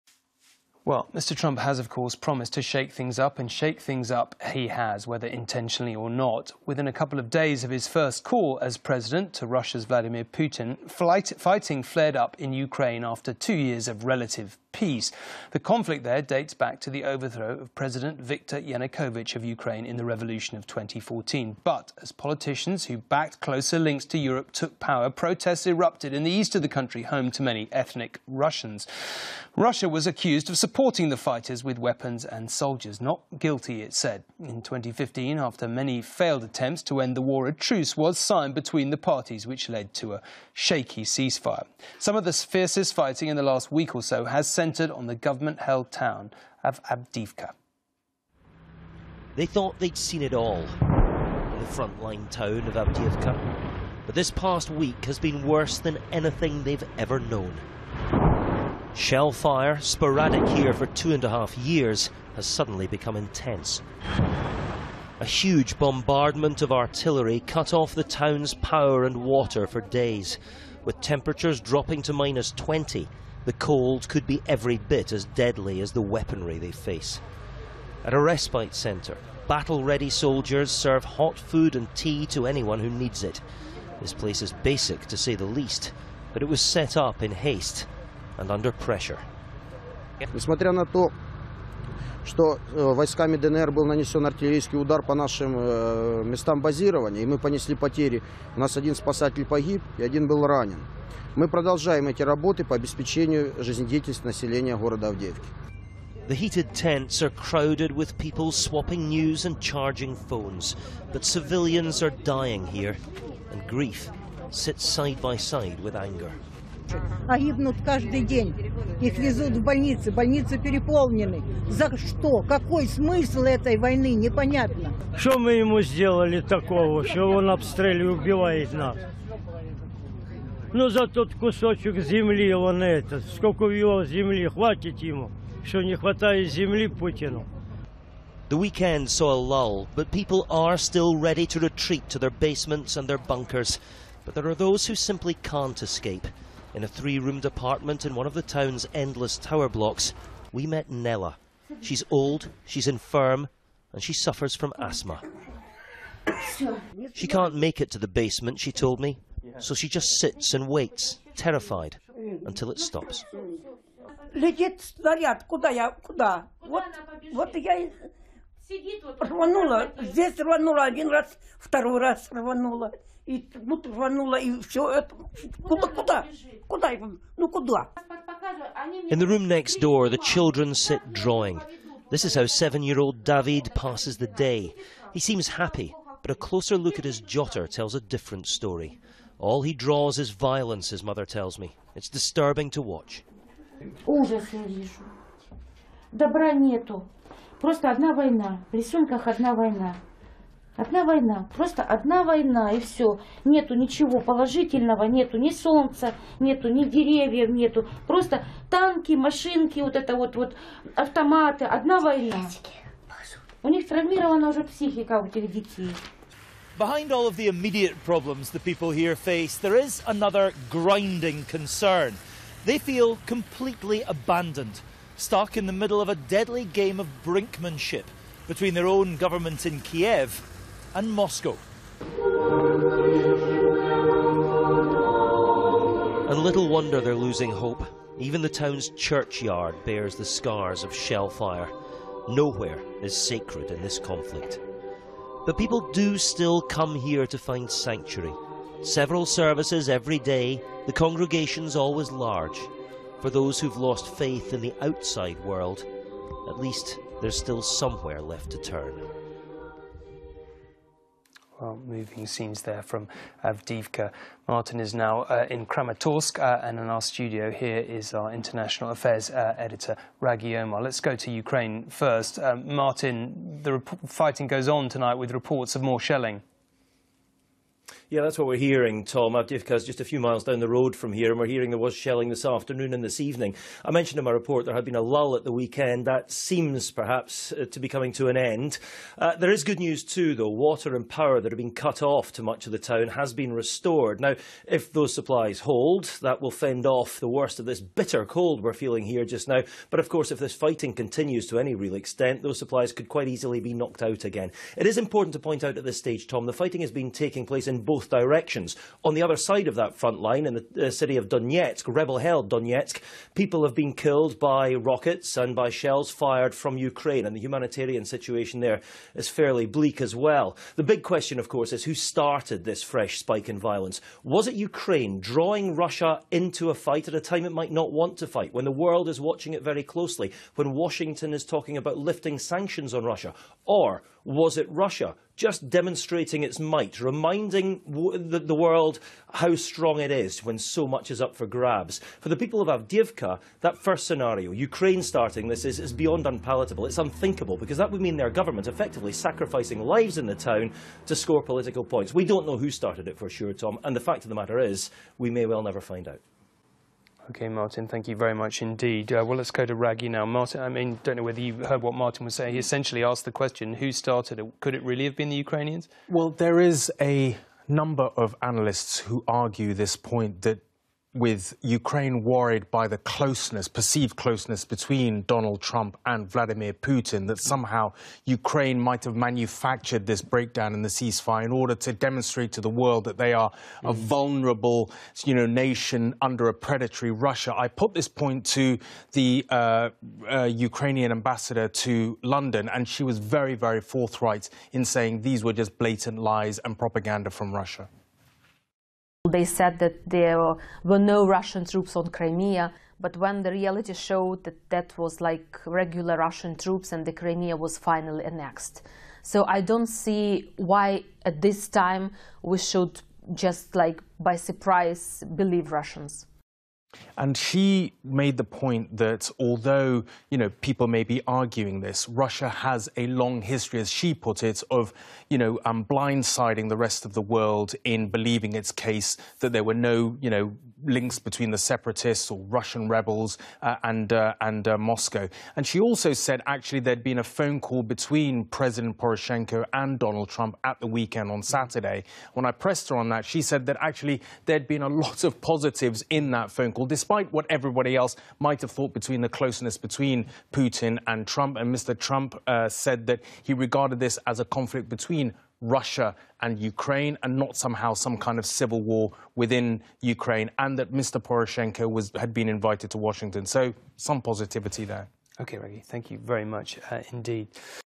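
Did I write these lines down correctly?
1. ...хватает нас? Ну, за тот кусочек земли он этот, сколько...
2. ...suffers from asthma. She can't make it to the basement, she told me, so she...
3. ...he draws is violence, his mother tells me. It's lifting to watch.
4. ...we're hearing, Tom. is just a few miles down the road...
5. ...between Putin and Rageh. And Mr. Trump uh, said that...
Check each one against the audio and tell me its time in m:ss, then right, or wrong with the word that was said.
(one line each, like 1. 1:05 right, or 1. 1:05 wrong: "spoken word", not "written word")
1. 2:08 wrong: "убивает", not "хватает"
2. 2:34 right
3. 3:09 wrong: "disturbing", not "lifting"
4. 4:38 right
5. 7:29 wrong: "Trump", not "Rageh".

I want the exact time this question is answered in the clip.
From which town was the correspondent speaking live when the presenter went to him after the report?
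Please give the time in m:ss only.
4:25.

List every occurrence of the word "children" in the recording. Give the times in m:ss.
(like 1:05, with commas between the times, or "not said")
3:00.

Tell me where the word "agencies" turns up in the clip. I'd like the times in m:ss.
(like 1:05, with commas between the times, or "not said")
not said.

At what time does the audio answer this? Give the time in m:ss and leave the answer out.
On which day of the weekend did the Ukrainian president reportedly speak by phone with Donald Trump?
7:21.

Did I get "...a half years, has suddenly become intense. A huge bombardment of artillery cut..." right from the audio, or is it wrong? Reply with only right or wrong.
right.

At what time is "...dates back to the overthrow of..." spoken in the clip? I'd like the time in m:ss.
0:16.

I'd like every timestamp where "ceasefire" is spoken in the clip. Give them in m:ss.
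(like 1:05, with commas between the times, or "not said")
0:41, 6:20.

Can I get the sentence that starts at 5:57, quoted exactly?
Okay, Martin, thank you very much indeed.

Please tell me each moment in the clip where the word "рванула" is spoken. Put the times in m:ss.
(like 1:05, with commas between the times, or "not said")
2:53.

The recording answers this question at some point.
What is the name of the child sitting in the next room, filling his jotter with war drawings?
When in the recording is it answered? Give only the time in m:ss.
3:03.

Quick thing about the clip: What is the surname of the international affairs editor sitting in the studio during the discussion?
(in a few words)
Omaar.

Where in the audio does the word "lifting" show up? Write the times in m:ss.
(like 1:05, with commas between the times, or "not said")
5:31.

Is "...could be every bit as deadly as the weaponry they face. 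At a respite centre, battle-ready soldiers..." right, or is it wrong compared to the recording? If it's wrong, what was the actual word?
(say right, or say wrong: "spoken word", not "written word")
right.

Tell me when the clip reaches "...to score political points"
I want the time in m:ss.
5:51.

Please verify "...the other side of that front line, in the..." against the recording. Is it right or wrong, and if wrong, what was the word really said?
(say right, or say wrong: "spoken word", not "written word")
right.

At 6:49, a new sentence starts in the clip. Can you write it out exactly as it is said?
So I don't see why at this time we should just like by surprise believe Russians.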